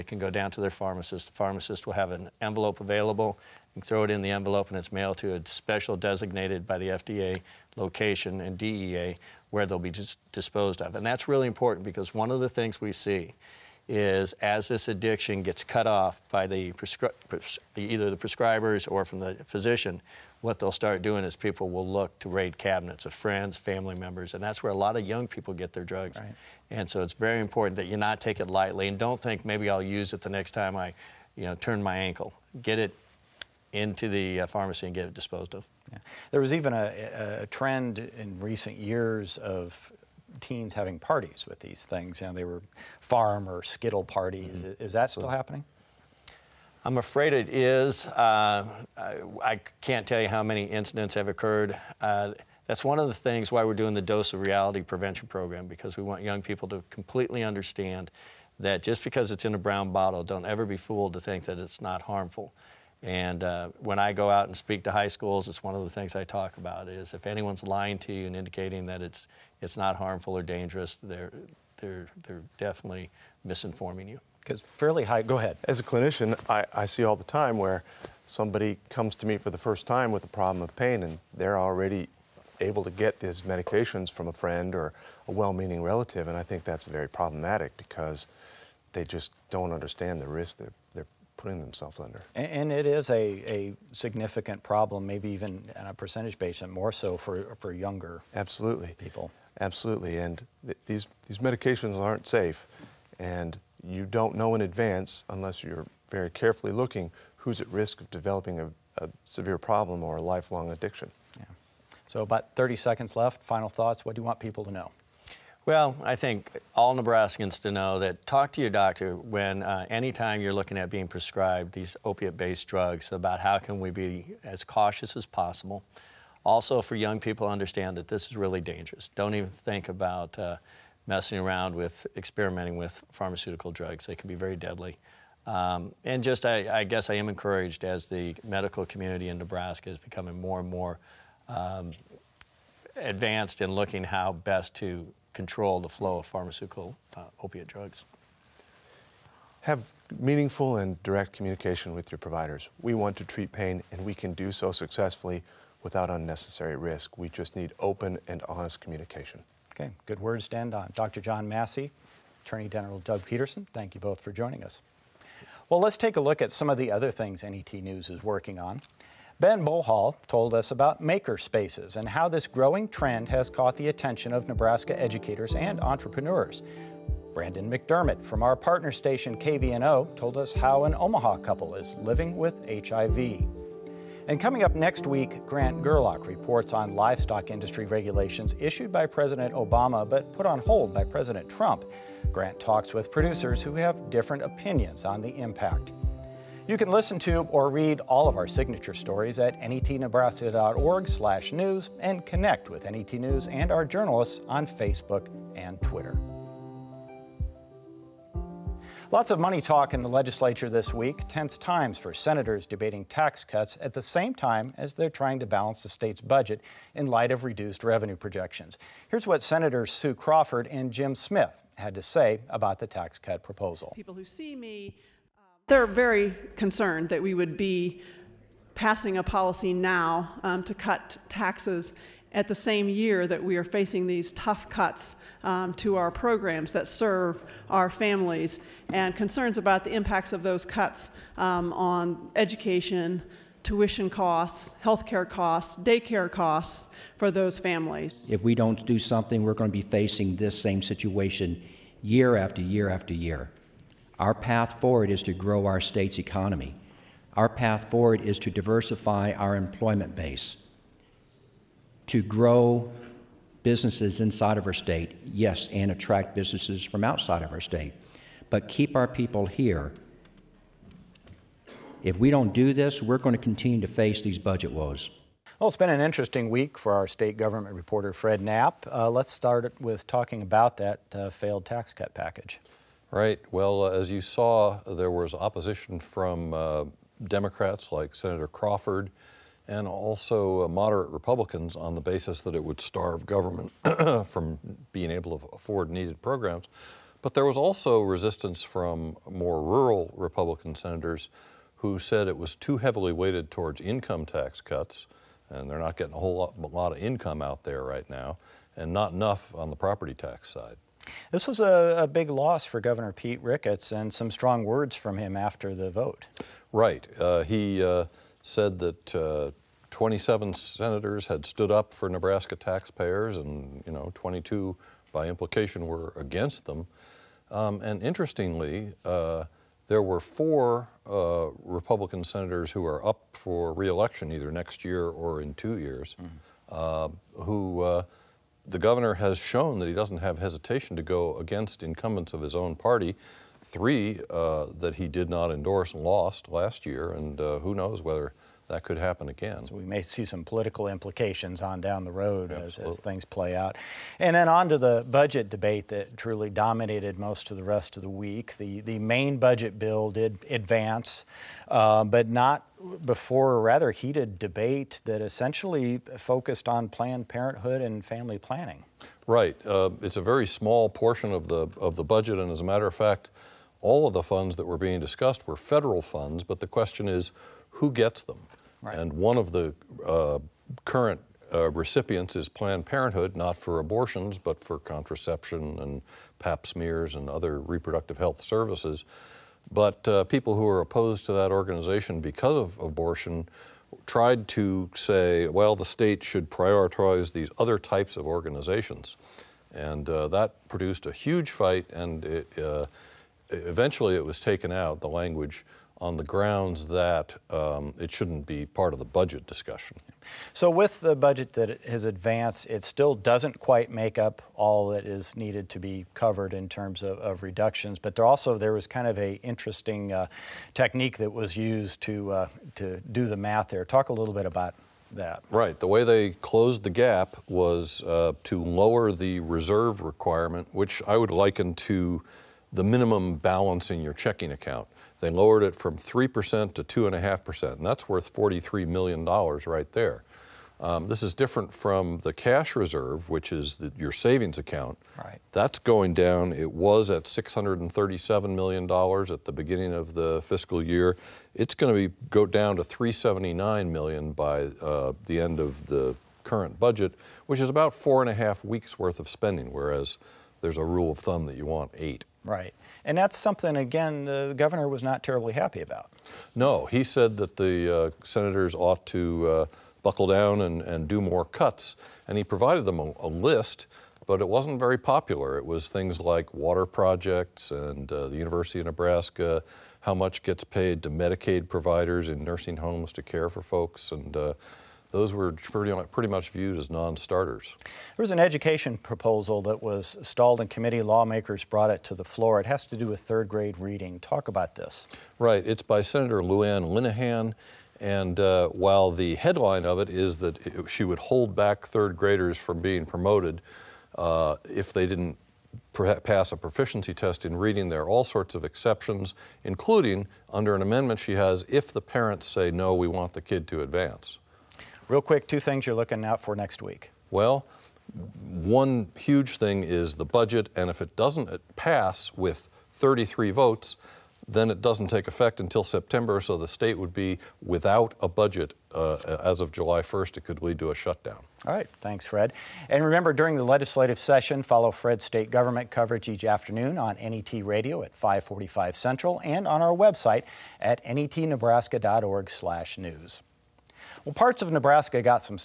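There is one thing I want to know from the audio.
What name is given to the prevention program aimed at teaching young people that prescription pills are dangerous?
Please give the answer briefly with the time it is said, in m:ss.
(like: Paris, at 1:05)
Dose of Reality, at 0:54.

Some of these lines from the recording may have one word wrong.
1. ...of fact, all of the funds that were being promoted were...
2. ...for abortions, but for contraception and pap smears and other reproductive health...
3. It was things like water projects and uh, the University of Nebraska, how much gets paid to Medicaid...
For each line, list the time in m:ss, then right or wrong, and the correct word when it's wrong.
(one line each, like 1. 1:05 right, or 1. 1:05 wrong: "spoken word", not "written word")
1. 6:12 wrong: "discussed", not "promoted"
2. 6:23 right
3. 7:55 right.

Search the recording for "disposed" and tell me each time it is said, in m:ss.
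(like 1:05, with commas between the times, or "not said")
0:10, 0:35.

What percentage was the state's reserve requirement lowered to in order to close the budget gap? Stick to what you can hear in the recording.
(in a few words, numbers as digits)
2.5%.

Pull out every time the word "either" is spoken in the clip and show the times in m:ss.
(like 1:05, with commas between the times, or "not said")
0:17, 5:34.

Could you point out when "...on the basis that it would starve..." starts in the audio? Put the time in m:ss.
4:51.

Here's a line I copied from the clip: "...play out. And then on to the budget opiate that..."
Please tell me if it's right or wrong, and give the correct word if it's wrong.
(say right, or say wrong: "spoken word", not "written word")
wrong: "debate", not "opiate".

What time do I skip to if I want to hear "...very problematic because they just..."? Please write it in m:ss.
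1:26.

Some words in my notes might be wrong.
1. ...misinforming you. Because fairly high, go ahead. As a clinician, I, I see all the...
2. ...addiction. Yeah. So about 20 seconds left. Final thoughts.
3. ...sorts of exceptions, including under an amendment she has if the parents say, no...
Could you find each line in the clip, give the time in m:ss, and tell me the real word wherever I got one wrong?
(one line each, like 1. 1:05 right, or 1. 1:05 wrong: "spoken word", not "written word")
1. 1:13 right
2. 1:50 wrong: "30", not "20"
3. 8:28 right.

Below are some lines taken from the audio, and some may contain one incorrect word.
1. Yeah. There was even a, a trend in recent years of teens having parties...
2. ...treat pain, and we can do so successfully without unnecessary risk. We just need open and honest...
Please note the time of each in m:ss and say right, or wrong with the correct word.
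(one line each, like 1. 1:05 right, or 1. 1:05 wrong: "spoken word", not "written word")
1. 0:35 right
2. 2:33 right.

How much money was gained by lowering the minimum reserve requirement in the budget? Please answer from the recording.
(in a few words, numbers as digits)
$43 million.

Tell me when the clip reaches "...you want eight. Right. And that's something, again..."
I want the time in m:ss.
7:41.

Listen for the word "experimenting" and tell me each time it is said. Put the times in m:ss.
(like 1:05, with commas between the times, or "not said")
2:12.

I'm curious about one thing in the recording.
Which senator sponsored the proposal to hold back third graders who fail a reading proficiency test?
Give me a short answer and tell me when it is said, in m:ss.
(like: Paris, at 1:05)
Lou Ann Linehan, at 8:16.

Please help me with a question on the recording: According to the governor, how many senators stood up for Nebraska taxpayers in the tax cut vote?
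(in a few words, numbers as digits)
27.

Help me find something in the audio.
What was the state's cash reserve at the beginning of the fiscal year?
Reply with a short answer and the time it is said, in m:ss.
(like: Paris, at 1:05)
$637 million, at 7:27.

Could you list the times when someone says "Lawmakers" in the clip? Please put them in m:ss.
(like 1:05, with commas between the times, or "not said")
8:11.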